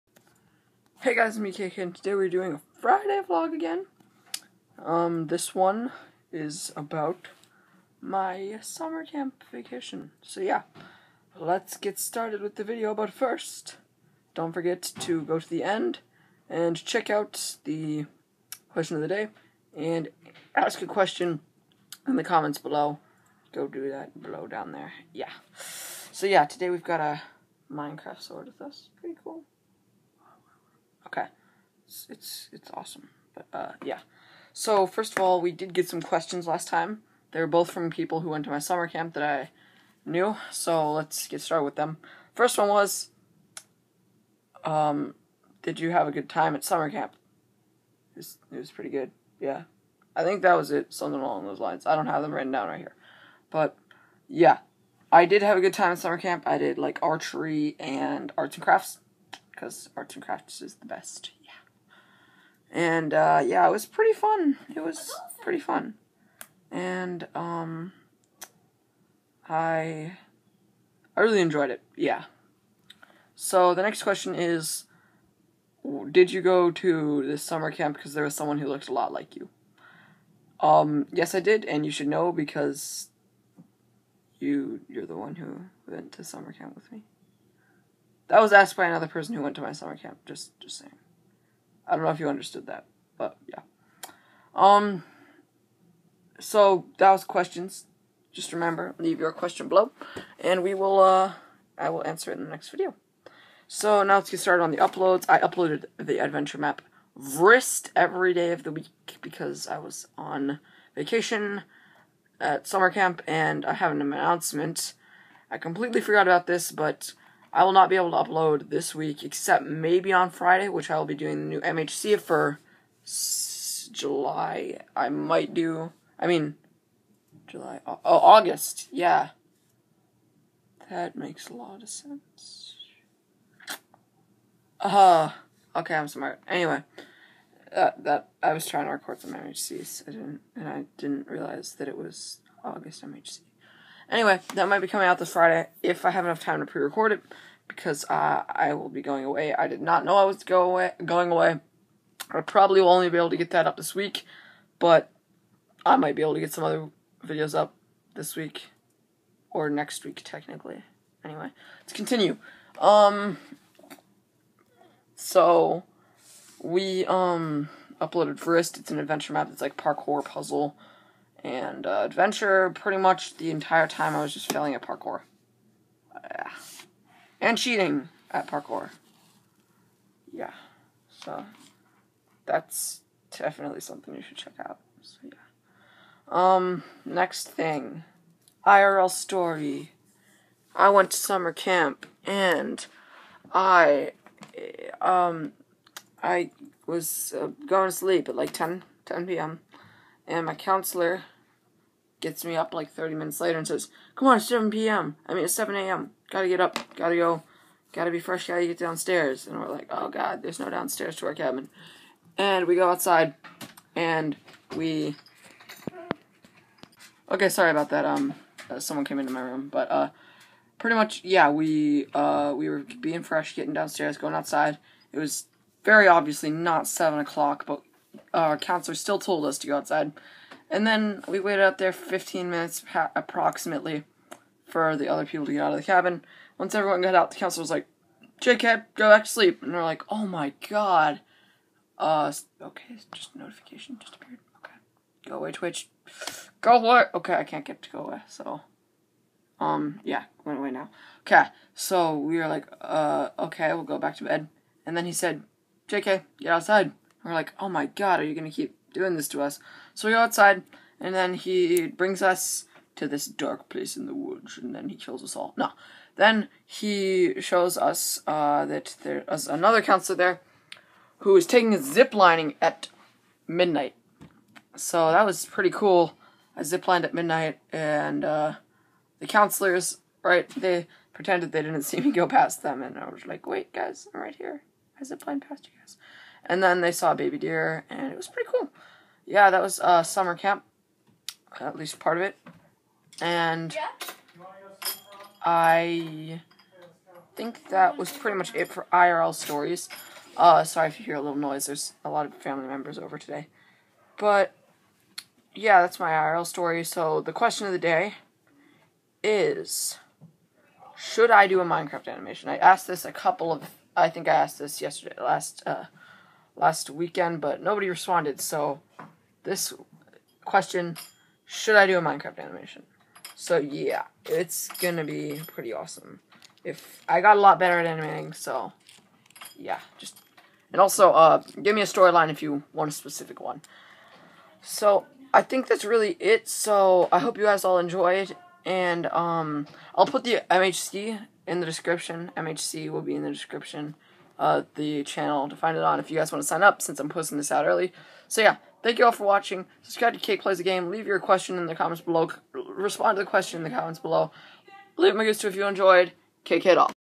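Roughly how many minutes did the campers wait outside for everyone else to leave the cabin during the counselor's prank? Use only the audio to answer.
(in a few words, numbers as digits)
15.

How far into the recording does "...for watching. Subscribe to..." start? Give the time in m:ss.
5:49.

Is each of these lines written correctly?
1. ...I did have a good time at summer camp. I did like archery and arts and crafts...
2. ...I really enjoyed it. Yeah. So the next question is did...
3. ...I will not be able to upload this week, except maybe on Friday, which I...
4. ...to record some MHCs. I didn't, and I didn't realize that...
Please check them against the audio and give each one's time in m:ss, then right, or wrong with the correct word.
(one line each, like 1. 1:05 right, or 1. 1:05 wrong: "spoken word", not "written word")
1. 0:55 right
2. 1:11 right
3. 1:57 right
4. 2:18 right.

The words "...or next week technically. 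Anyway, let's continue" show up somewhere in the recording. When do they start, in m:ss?
2:39.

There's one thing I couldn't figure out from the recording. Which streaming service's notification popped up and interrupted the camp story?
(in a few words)
Twitch.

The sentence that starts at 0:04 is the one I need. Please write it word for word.
Um, this one is about my summer camp vacation.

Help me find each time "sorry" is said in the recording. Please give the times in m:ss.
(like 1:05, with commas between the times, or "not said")
3:37, 5:00.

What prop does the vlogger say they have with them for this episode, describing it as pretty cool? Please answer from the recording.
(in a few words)
Minecraft sword.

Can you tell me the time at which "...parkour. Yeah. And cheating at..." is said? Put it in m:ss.
2:54.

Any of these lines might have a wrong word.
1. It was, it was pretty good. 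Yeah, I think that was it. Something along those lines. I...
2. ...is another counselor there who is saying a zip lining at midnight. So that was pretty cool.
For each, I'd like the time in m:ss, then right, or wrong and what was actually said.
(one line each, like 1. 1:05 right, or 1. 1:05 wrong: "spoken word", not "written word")
1. 0:48 right
2. 4:29 wrong: "taking", not "saying".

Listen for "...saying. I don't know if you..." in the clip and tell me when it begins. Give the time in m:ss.
1:30.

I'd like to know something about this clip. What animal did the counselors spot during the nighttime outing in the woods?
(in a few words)
baby deer.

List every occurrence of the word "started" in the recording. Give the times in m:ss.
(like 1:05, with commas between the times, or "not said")
0:11, 0:41, 1:44.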